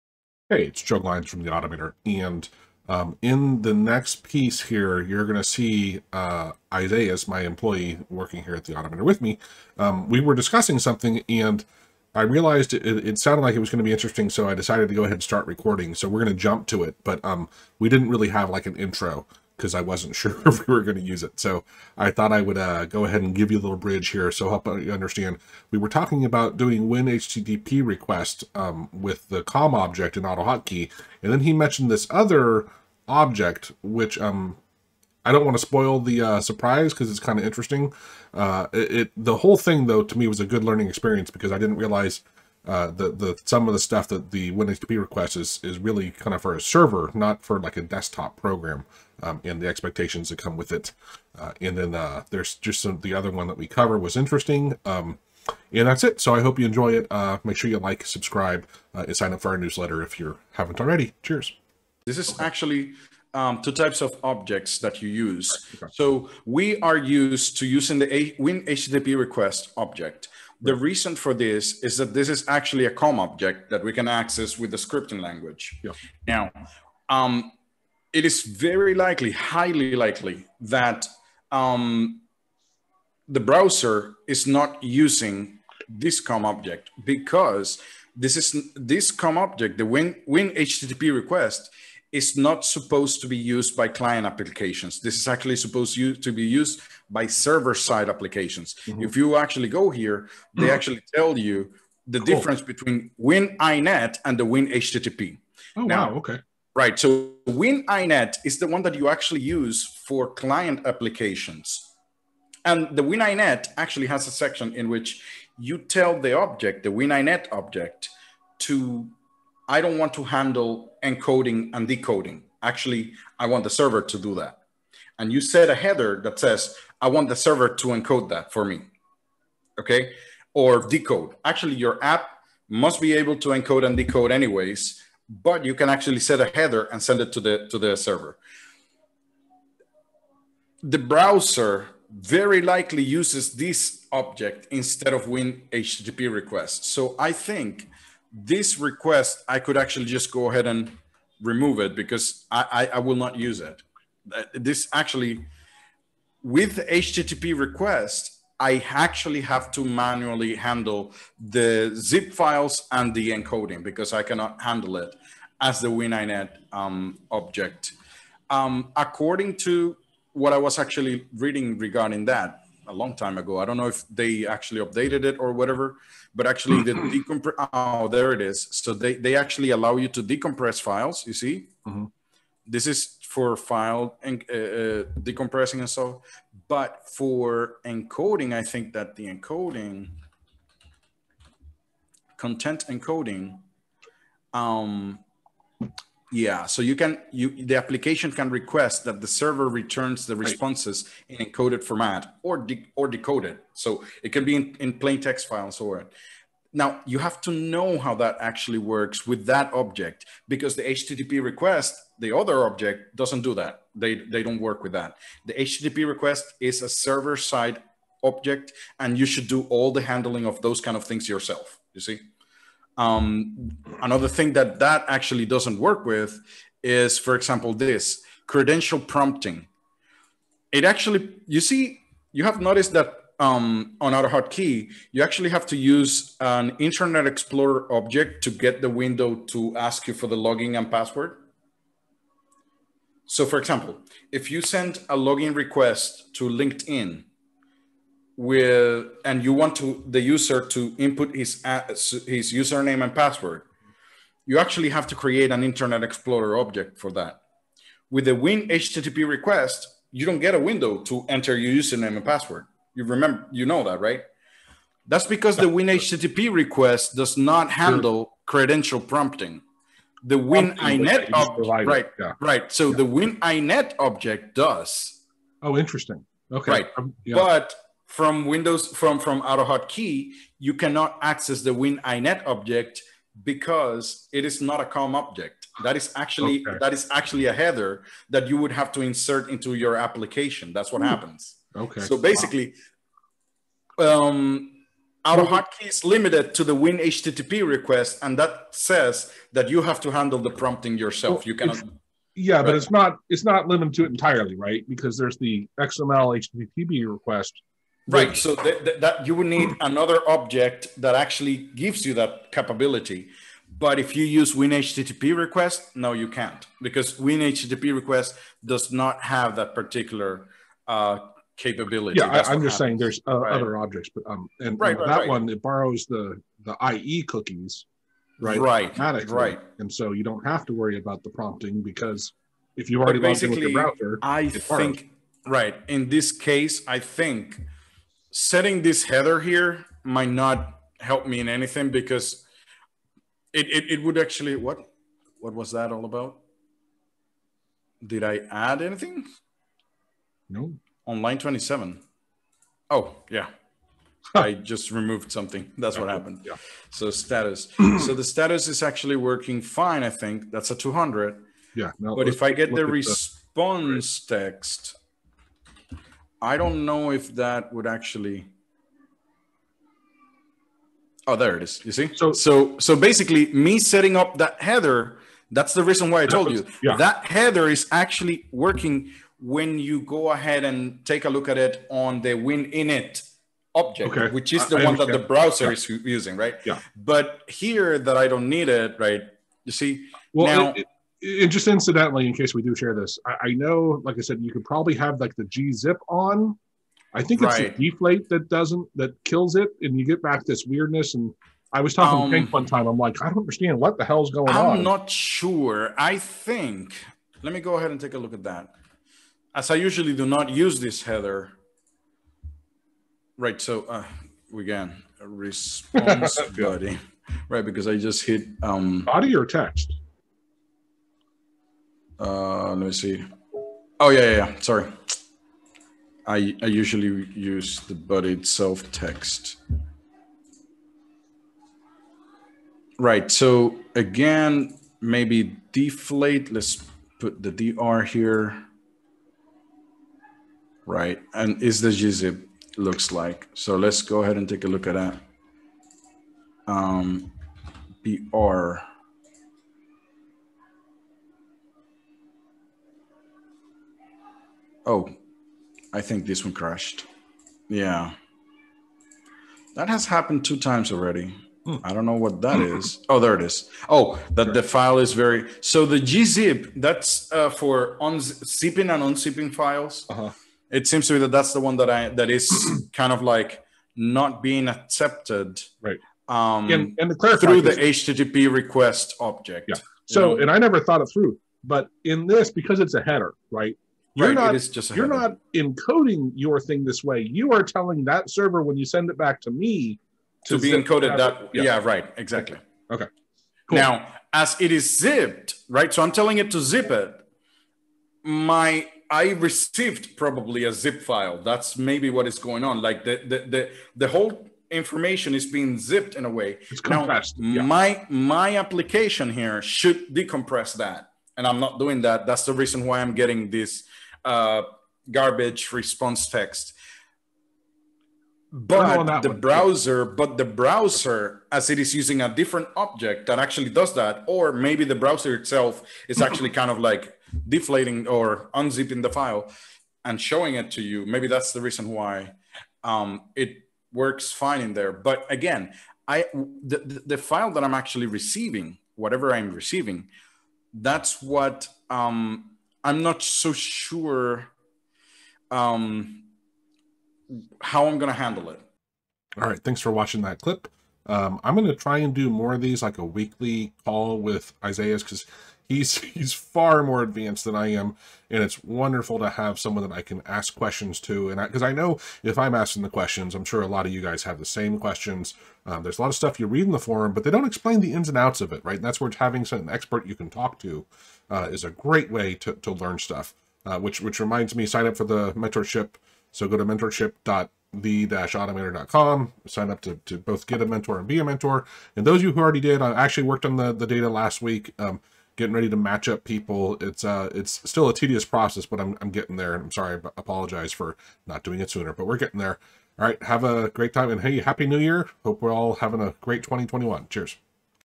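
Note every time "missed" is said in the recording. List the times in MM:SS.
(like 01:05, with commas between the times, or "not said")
not said.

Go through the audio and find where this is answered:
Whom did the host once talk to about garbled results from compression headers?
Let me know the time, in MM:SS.
06:42.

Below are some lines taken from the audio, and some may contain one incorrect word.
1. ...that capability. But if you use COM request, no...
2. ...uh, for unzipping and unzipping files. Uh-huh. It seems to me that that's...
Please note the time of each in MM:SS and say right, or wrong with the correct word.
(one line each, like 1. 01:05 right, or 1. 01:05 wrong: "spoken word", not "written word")
1. 05:12 wrong: "WinHTTP", not "COM"
2. 07:47 right.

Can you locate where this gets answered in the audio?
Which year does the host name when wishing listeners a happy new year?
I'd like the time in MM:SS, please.
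09:56.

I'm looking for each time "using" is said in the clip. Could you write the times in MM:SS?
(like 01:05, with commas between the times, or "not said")
01:07, 01:24, 06:25, 08:41.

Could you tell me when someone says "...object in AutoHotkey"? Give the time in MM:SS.
00:29.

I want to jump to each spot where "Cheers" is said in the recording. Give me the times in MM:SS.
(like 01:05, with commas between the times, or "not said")
01:01, 09:57.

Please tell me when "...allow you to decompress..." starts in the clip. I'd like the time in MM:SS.
02:59.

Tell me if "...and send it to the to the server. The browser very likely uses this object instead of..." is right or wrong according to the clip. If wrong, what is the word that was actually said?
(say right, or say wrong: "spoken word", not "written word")
right.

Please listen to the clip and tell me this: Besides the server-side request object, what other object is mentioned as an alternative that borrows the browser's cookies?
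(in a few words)
XML HTTP request.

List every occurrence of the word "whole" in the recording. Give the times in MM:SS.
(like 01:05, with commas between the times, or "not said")
00:39, 08:24.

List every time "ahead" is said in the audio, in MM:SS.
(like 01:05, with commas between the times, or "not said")
00:15, 00:23, 02:30, 06:20, 06:47, 07:24.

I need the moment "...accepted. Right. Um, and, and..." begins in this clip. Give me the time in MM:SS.
07:54.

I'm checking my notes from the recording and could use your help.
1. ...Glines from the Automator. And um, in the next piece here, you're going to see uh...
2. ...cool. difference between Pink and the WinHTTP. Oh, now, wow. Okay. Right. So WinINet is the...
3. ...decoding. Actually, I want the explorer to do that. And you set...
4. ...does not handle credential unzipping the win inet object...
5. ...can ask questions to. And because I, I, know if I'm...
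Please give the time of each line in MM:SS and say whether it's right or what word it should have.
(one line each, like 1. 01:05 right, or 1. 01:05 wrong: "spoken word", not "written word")
1. 00:00 right
2. 01:42 wrong: "WinINet", not "Pink"
3. 02:01 wrong: "server", not "explorer"
4. 04:27 wrong: "prompting", not "unzipping"
5. 09:20 right.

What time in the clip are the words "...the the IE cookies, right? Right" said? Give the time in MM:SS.
05:26.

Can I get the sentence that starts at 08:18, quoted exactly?
My I received probably a zip file.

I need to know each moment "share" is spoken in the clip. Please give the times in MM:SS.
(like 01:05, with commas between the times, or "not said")
06:32.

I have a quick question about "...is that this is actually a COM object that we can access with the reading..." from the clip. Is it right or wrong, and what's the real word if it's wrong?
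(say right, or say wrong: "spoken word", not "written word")
wrong: "scripting", not "reading".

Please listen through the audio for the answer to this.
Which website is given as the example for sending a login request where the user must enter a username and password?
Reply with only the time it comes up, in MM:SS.
04:06.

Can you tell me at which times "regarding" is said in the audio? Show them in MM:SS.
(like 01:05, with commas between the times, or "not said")
02:51.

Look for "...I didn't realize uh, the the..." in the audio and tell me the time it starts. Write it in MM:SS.
00:41.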